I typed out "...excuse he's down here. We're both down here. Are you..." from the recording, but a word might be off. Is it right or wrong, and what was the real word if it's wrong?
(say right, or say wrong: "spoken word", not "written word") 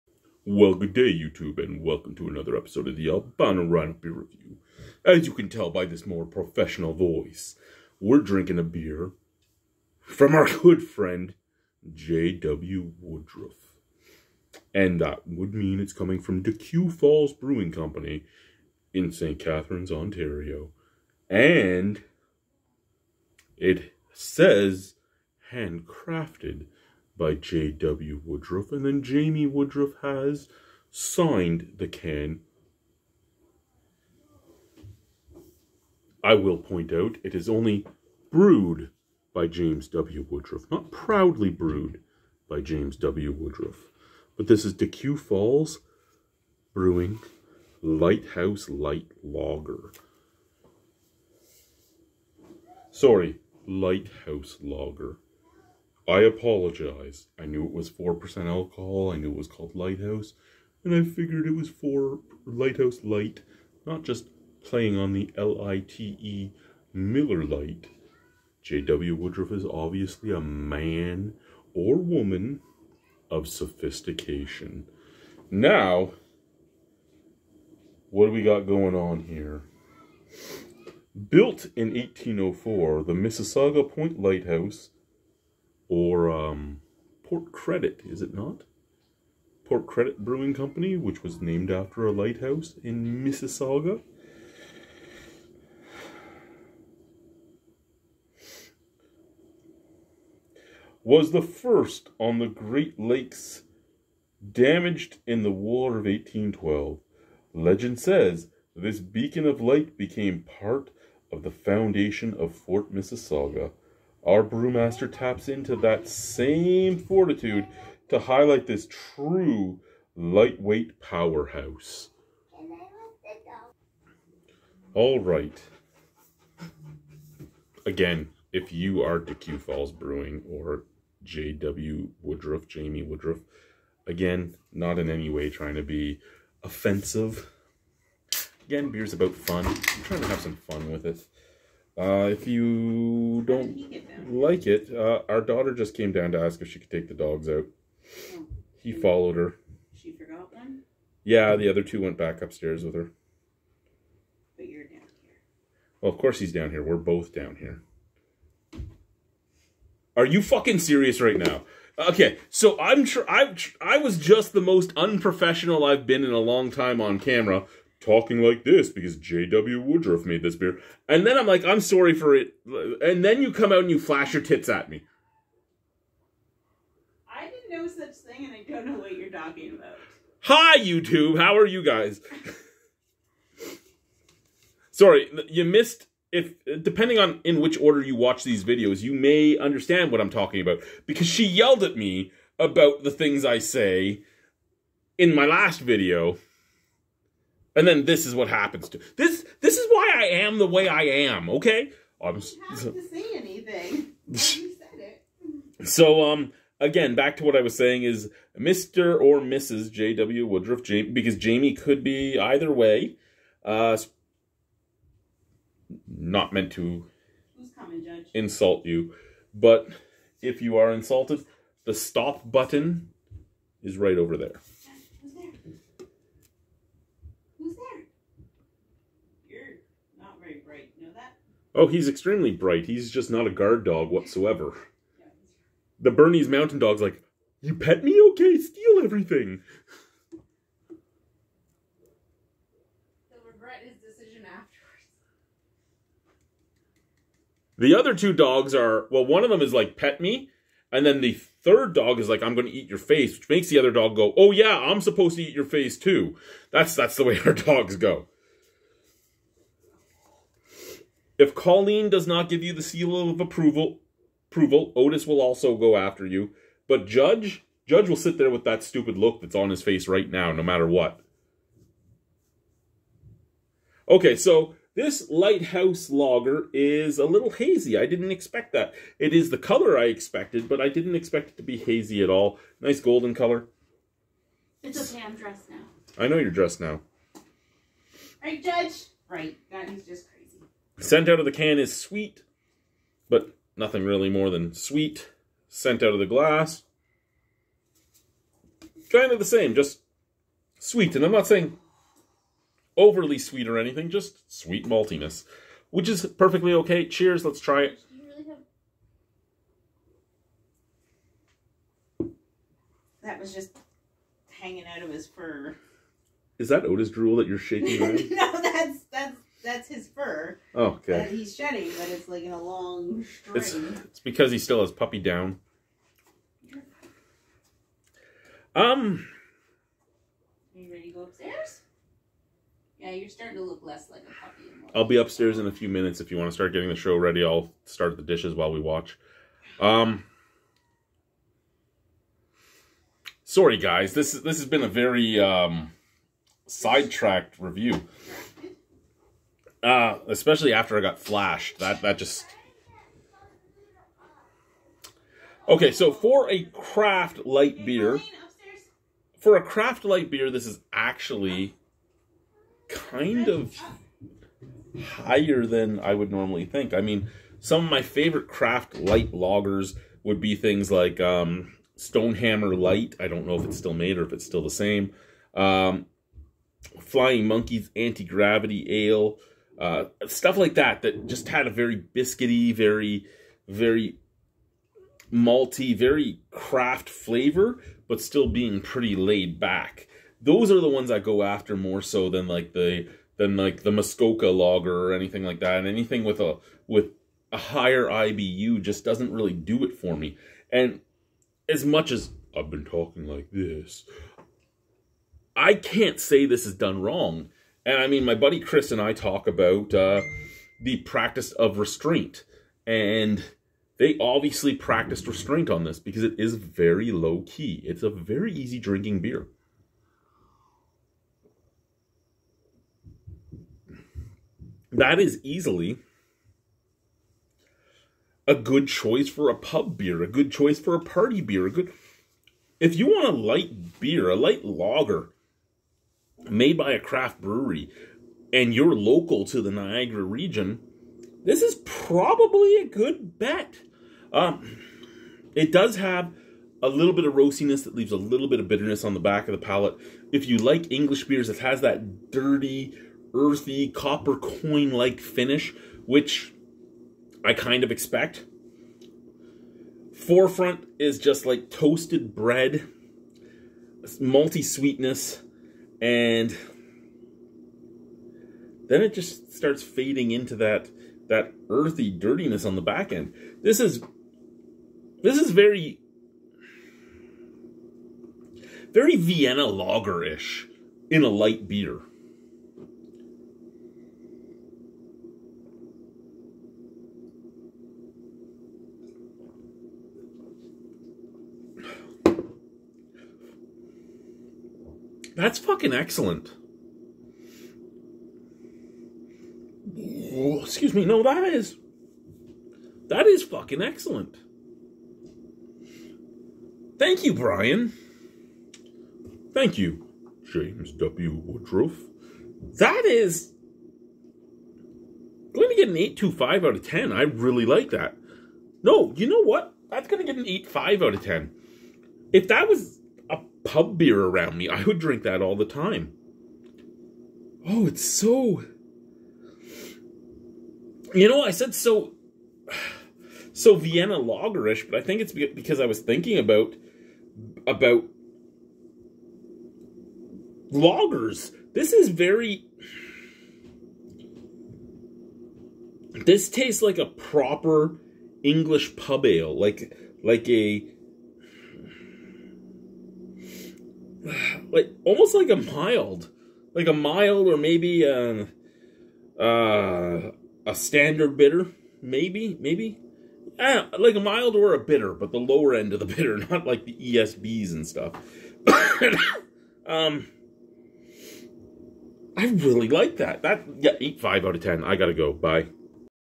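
wrong: "course", not "excuse".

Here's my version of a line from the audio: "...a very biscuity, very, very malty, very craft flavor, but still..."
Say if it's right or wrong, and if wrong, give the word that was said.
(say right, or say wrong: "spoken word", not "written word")
right.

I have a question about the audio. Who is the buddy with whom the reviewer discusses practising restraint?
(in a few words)
Chris.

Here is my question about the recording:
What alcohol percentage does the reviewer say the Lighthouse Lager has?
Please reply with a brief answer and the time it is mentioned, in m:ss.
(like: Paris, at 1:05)
4%, at 0:57.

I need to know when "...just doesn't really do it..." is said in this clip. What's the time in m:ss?
6:38.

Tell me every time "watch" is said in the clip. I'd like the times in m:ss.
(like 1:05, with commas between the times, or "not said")
3:08, 5:38.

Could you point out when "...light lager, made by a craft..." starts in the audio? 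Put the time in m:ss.
7:14.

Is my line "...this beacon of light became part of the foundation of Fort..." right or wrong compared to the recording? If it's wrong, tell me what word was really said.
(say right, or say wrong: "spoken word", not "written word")
right.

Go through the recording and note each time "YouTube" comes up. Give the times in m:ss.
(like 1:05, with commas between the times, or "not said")
0:01, 3:00.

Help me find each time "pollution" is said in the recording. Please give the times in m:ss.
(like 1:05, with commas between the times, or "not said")
not said.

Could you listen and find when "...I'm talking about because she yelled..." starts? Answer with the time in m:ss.
3:10.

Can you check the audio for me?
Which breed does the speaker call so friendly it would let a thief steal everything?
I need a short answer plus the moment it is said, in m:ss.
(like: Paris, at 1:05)
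Bernese Mountain Dog, at 3:56.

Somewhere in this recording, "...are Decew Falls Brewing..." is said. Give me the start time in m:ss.
2:09.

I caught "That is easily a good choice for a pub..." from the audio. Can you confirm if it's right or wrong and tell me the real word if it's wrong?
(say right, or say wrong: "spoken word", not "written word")
right.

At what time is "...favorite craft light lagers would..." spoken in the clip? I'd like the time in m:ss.
6:08.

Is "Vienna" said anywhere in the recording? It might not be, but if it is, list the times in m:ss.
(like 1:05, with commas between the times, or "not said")
7:59, 8:53.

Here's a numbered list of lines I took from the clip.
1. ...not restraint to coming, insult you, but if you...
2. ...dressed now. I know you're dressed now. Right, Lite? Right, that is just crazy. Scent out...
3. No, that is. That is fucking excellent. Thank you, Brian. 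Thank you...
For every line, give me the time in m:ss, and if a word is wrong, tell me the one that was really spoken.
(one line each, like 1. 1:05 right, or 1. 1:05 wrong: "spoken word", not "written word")
1. 3:36 wrong: "meant", not "restraint"
2. 4:45 wrong: "Judge", not "Lite"
3. 8:21 right.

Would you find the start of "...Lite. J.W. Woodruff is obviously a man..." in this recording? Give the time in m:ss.
1:07.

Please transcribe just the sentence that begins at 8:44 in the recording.
I would drink that all the time.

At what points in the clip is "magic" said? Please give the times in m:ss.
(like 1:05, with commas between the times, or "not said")
not said.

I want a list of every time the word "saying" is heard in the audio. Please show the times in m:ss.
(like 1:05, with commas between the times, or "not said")
3:27, 5:01.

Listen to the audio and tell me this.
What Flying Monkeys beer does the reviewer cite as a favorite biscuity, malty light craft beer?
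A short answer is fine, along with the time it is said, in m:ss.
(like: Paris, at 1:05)
Anti Gravity Ale, at 6:17.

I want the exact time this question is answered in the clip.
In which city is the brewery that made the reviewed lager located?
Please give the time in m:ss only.
0:19.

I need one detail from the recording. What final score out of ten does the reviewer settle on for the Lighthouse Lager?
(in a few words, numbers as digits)
8.5.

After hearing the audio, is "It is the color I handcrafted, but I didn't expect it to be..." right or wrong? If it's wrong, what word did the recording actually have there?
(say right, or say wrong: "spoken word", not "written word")
wrong: "expected", not "handcrafted".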